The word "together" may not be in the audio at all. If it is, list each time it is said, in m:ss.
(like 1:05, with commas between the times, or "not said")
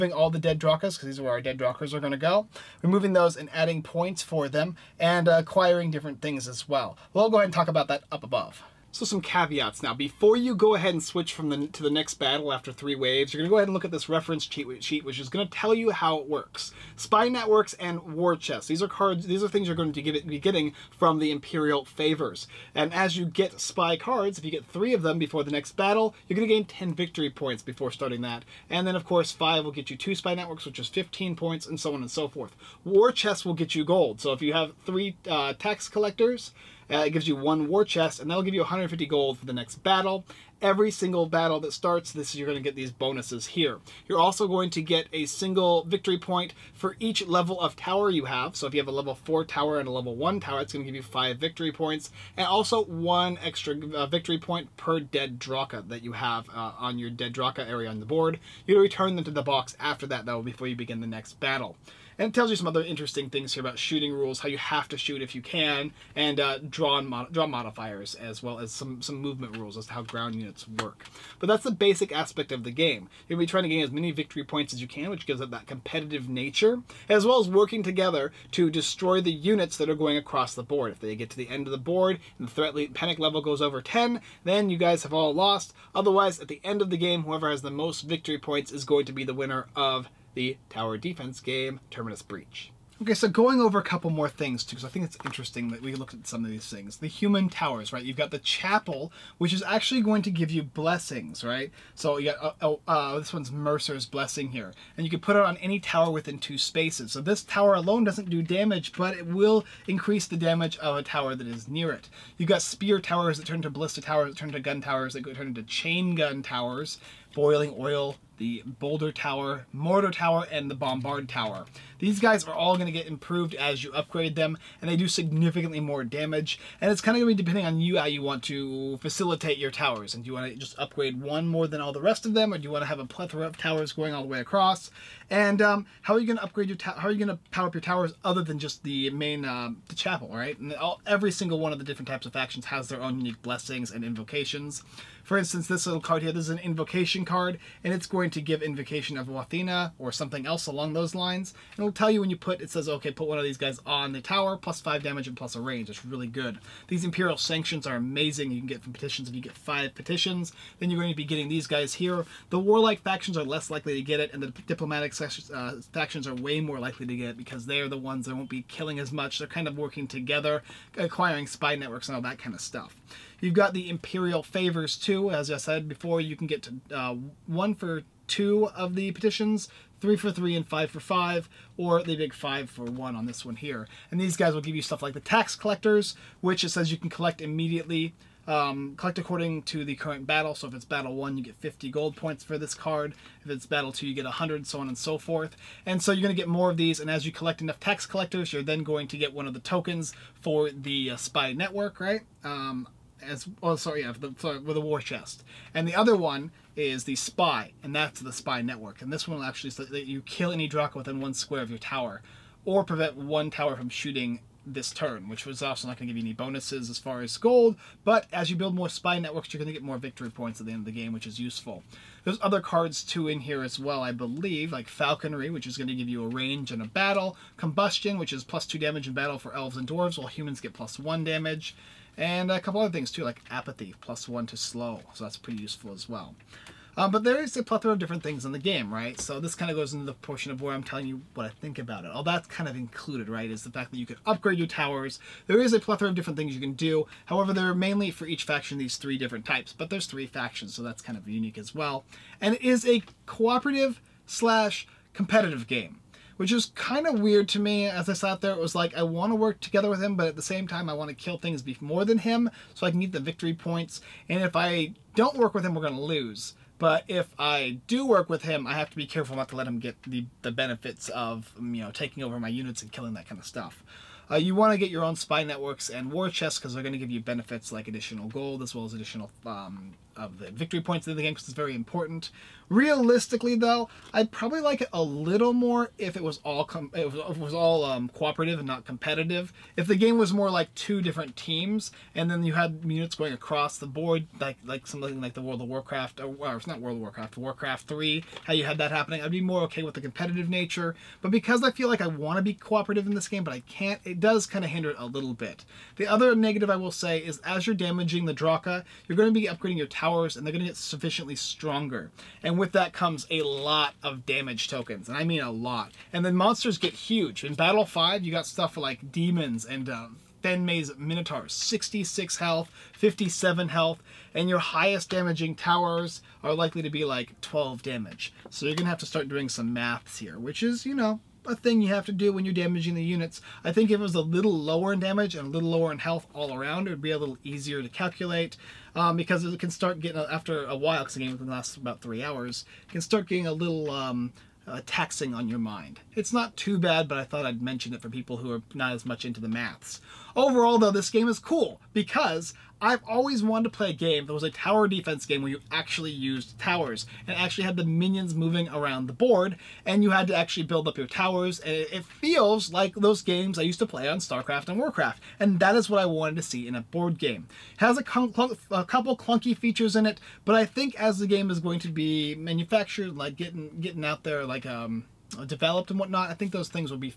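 1:17, 2:50, 4:19.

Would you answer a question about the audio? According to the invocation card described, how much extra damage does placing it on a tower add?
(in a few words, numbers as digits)
5.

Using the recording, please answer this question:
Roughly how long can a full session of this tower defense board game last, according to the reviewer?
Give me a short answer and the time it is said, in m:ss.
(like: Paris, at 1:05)
3 hours, at 5:42.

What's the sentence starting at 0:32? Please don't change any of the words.
War chests will get you gold.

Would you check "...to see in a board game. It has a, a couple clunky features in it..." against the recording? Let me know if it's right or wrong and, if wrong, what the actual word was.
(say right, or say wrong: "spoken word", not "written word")
right.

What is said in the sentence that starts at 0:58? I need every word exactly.
You return them to the box after that, though, before you begin the next battle.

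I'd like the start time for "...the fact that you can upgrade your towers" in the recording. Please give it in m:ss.
4:03.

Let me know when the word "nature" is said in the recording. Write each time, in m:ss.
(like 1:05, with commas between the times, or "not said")
1:16, 5:00.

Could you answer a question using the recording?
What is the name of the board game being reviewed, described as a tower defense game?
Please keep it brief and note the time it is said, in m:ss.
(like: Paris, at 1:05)
Terminus Breach, at 1:31.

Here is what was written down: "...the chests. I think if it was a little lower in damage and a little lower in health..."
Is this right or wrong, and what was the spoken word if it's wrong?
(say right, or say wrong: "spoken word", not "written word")
wrong: "units", not "chests".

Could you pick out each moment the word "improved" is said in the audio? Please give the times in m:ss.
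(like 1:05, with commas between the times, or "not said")
2:03.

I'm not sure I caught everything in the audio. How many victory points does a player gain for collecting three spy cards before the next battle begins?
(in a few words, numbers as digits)
10.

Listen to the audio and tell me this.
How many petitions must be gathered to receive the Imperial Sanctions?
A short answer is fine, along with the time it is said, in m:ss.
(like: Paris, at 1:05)
5, at 2:39.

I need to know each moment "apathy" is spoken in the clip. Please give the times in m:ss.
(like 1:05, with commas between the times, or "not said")
3:53.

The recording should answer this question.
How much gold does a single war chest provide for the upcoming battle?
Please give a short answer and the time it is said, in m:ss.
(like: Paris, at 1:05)
150 gold, at 0:38.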